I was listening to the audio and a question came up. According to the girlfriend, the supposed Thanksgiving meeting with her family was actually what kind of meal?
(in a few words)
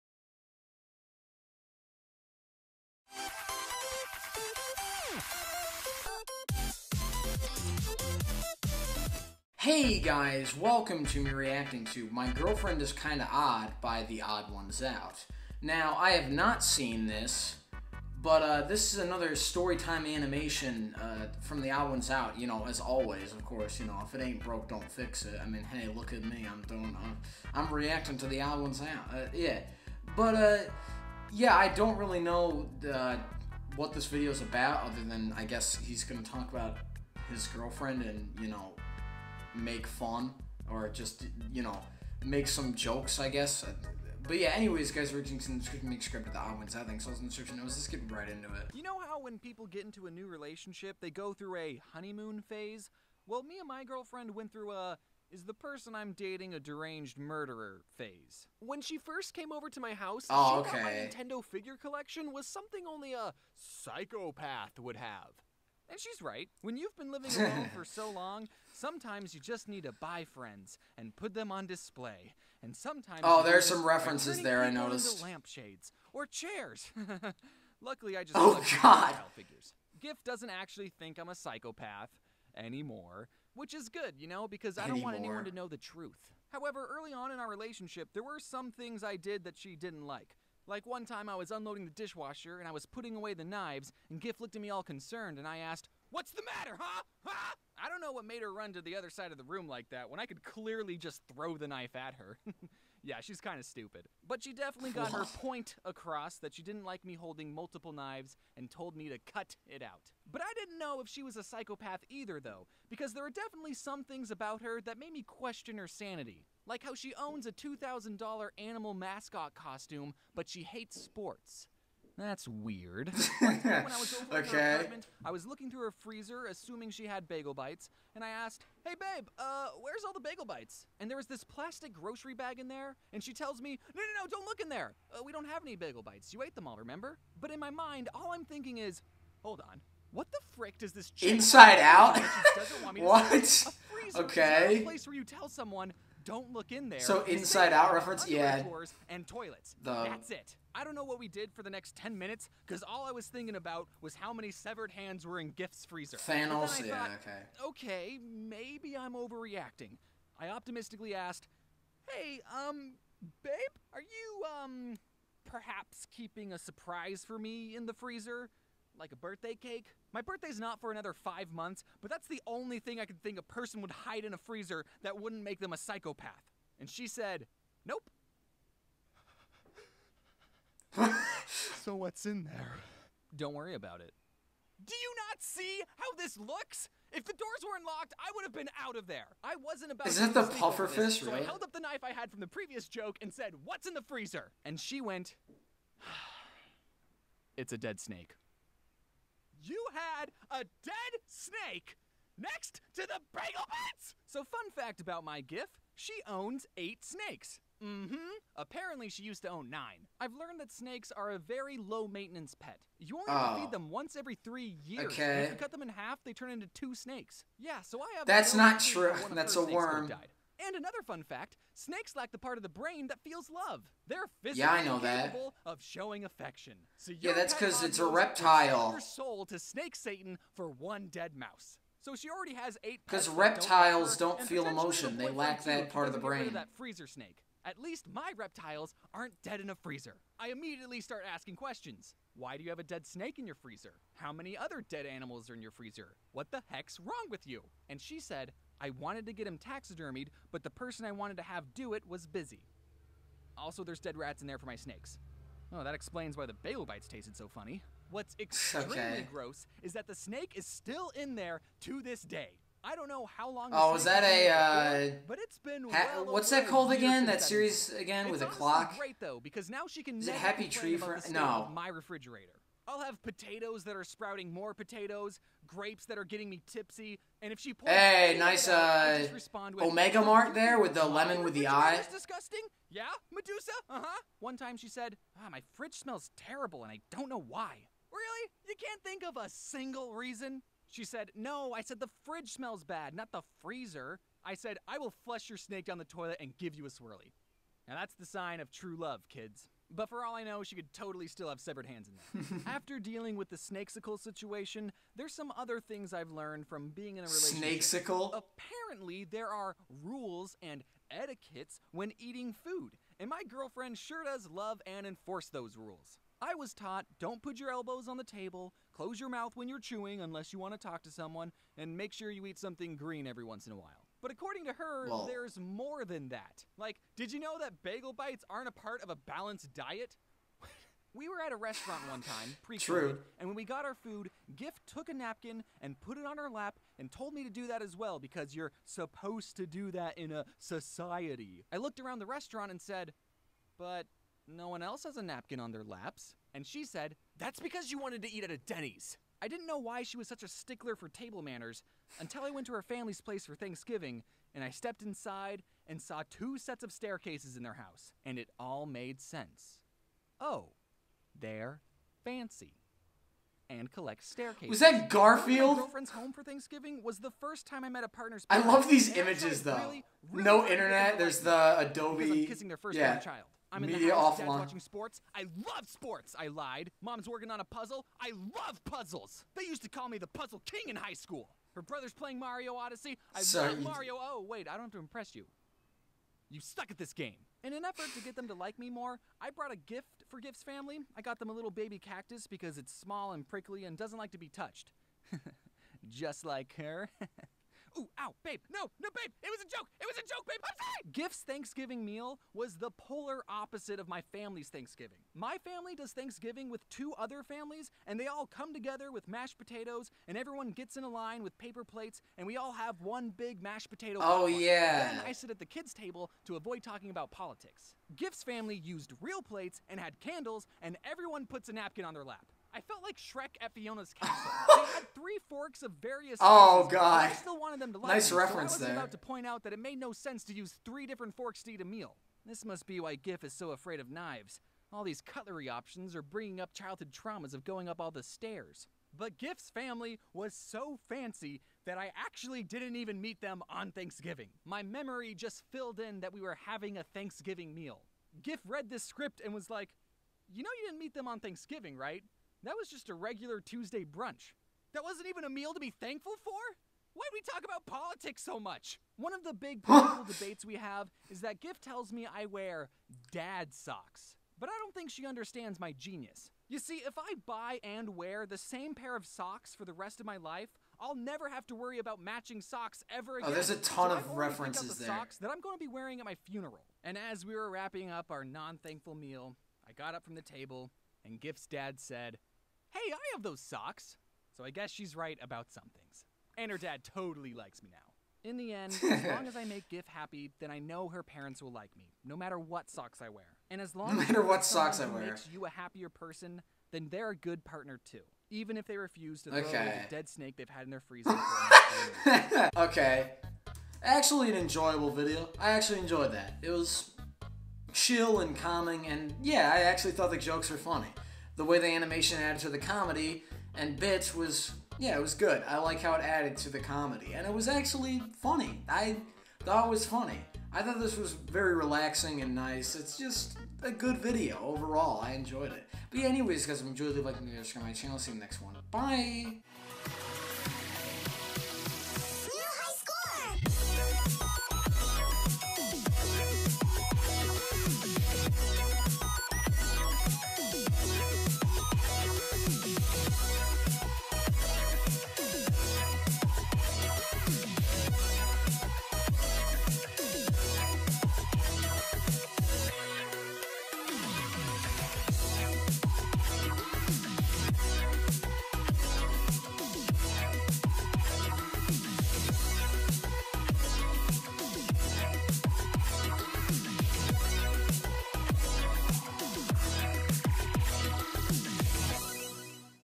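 Tuesday brunch.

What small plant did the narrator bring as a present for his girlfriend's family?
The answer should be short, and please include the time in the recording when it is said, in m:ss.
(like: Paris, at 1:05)
Baby cactus, at 6:31.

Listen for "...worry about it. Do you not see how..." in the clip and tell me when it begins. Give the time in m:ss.
3:03.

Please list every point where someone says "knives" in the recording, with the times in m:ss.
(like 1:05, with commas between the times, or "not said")
1:33, 1:47, 7:14.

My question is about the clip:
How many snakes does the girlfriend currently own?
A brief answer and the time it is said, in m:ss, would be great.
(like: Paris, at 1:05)
8, at 3:26.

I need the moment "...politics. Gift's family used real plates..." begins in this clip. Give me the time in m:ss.
6:57.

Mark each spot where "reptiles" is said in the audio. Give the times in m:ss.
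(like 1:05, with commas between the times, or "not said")
3:48, 3:53, 3:58.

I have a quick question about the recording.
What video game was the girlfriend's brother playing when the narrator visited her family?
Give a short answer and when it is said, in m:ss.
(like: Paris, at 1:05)
Mario Odyssey, at 6:22.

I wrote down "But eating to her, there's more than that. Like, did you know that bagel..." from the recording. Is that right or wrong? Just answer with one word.
wrong.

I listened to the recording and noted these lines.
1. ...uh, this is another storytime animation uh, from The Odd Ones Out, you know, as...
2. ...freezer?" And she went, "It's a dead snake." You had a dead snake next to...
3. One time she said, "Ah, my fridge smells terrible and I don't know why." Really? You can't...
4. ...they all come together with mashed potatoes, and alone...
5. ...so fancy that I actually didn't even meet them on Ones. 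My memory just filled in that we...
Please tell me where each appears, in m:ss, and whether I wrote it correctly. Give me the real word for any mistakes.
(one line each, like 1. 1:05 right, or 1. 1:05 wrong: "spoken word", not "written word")
1. 0:18 right
2. 3:14 right
3. 4:44 right
4. 6:48 wrong: "everyone", not "alone"
5. 7:20 wrong: "Thanksgiving", not "Ones".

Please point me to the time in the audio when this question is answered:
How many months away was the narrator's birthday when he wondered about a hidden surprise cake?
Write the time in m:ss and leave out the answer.
2:51.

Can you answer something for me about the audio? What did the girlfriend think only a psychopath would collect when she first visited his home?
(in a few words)
Nintendo figure collection.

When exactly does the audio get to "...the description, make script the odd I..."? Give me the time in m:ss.
0:45.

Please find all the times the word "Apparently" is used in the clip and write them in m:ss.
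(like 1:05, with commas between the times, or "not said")
3:28, 5:08.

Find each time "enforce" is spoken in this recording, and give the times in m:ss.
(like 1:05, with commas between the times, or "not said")
5:15.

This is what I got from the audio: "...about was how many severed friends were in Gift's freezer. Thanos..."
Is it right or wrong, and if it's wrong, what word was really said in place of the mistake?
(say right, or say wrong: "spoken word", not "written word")
wrong: "hands", not "friends".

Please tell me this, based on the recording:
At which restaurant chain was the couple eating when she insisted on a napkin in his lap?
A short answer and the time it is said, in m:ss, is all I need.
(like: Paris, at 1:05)
Denny's, at 5:48.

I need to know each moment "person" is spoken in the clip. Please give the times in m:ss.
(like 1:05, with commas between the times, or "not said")
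0:55, 2:53, 4:10, 8:16.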